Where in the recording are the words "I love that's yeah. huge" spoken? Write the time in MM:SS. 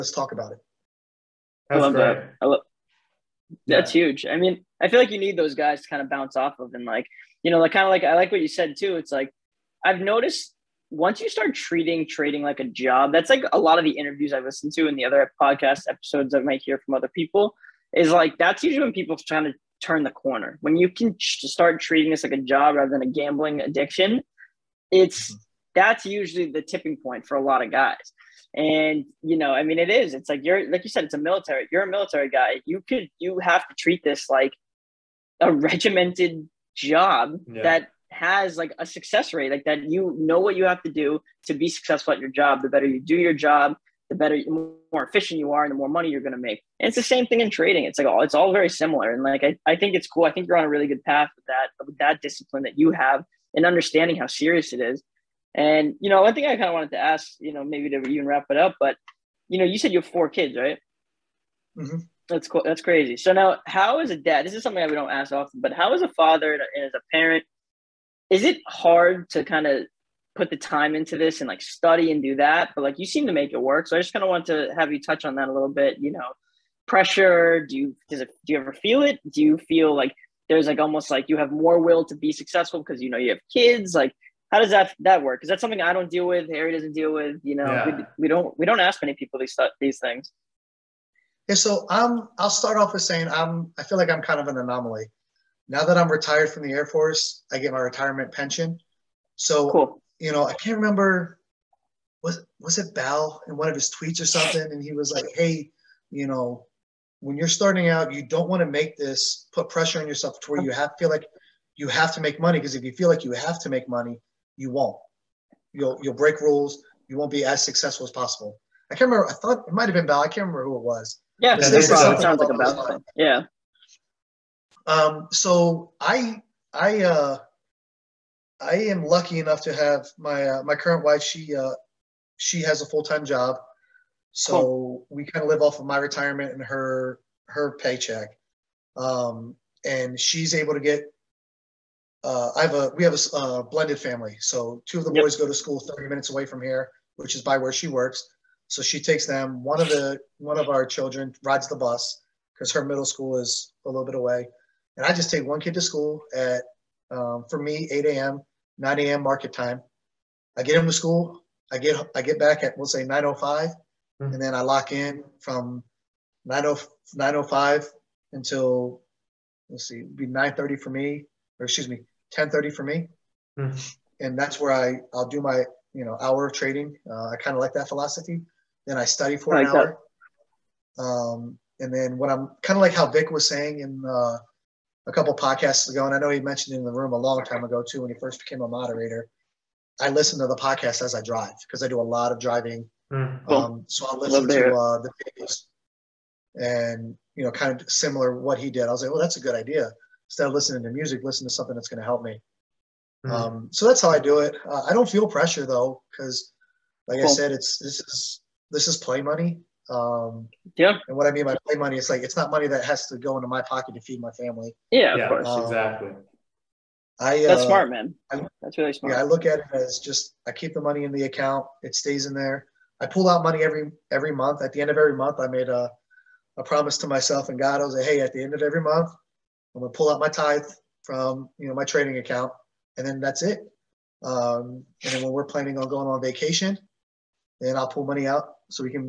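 00:02.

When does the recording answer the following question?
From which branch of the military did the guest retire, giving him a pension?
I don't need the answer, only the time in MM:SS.
01:36.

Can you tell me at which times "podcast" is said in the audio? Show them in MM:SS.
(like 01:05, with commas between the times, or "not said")
00:15, 03:05, 03:10.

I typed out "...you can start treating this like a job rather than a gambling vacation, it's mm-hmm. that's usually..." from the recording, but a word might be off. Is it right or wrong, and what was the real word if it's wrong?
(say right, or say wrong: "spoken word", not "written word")
wrong: "addiction", not "vacation".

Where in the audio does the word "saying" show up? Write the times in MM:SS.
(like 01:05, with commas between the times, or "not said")
01:33, 03:03.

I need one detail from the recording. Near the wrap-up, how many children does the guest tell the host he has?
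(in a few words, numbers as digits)
4.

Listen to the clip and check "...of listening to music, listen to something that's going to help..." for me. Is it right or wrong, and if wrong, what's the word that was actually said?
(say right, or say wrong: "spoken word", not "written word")
right.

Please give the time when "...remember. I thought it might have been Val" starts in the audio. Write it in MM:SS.
01:59.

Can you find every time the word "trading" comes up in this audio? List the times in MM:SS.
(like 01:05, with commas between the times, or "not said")
00:12, 00:47, 02:56, 03:51.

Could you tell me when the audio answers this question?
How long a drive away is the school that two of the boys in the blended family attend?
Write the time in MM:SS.
02:25.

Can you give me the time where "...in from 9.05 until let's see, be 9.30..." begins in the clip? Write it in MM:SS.
02:44.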